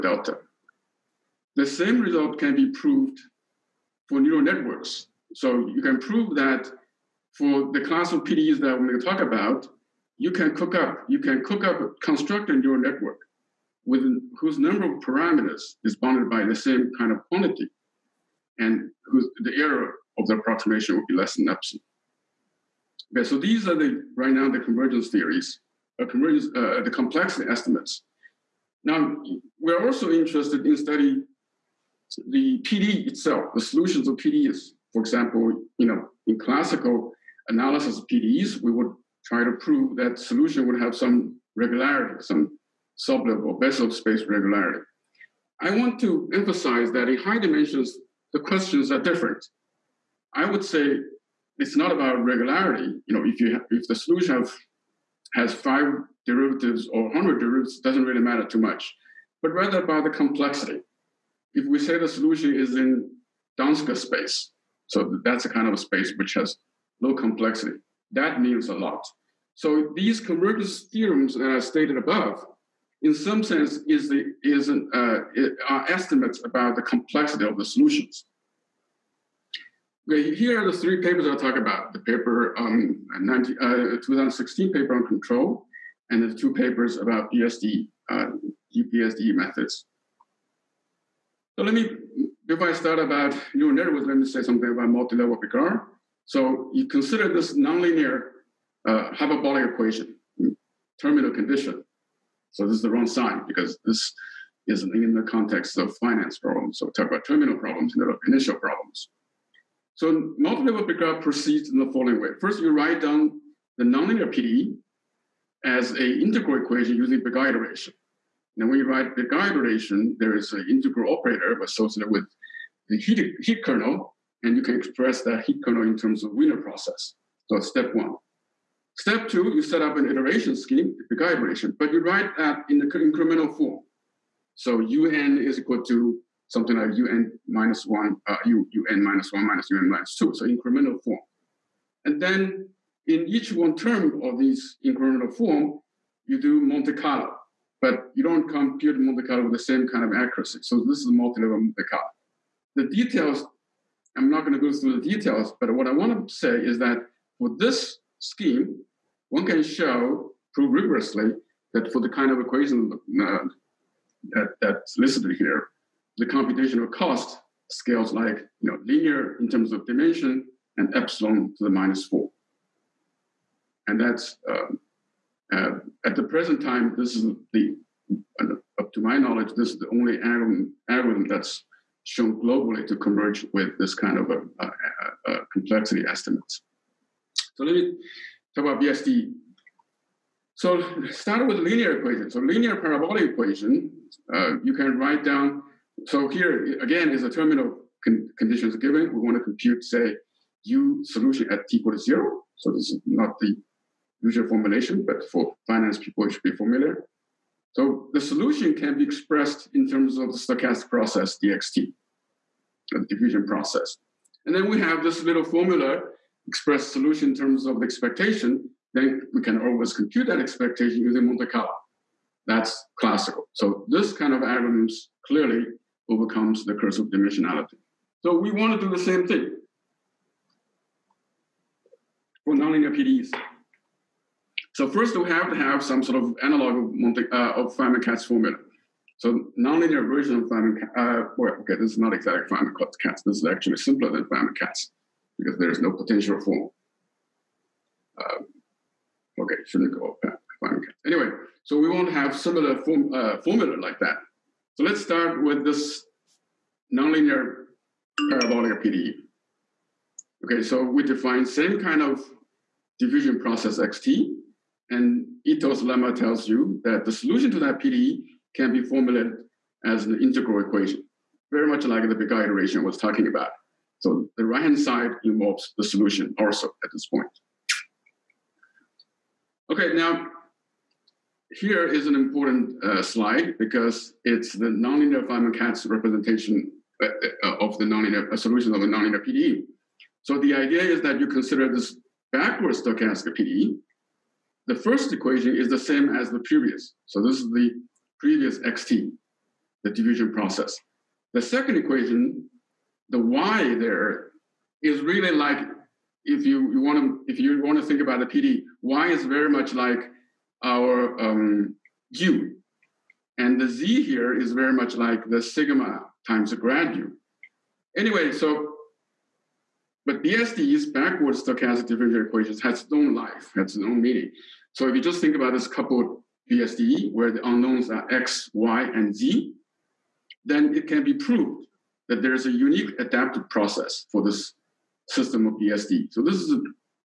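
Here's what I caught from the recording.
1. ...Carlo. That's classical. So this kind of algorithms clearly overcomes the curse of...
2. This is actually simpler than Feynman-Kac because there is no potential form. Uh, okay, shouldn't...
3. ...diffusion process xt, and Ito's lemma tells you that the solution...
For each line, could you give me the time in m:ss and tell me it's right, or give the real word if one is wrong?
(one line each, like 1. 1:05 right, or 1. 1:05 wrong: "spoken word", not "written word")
1. 3:41 right
2. 4:03 right
3. 4:22 right.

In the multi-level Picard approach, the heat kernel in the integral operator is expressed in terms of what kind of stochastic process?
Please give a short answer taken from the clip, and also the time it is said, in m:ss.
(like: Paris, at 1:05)
Wiener process, at 2:06.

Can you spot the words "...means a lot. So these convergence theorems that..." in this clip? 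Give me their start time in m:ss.
1:08.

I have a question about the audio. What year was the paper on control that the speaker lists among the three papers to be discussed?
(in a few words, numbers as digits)
2016.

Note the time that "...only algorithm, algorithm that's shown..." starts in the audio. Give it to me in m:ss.
2:59.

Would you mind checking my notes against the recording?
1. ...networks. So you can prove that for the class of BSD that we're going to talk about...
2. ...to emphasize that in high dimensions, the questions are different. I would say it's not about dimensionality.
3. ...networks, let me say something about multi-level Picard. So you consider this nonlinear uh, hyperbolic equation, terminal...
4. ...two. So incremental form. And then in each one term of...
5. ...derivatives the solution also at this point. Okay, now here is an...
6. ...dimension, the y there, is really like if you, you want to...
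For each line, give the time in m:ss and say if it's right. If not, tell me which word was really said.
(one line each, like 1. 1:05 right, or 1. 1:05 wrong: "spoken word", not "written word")
1. 0:04 wrong: "PDEs", not "BSD"
2. 0:45 wrong: "regularity", not "dimensionality"
3. 1:33 right
4. 2:20 right
5. 4:35 wrong: "involves", not "derivatives"
6. 5:01 wrong: "equation", not "dimension".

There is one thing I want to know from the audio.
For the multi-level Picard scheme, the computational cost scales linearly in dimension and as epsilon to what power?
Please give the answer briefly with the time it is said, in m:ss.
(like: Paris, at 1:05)
-4, at 2:51.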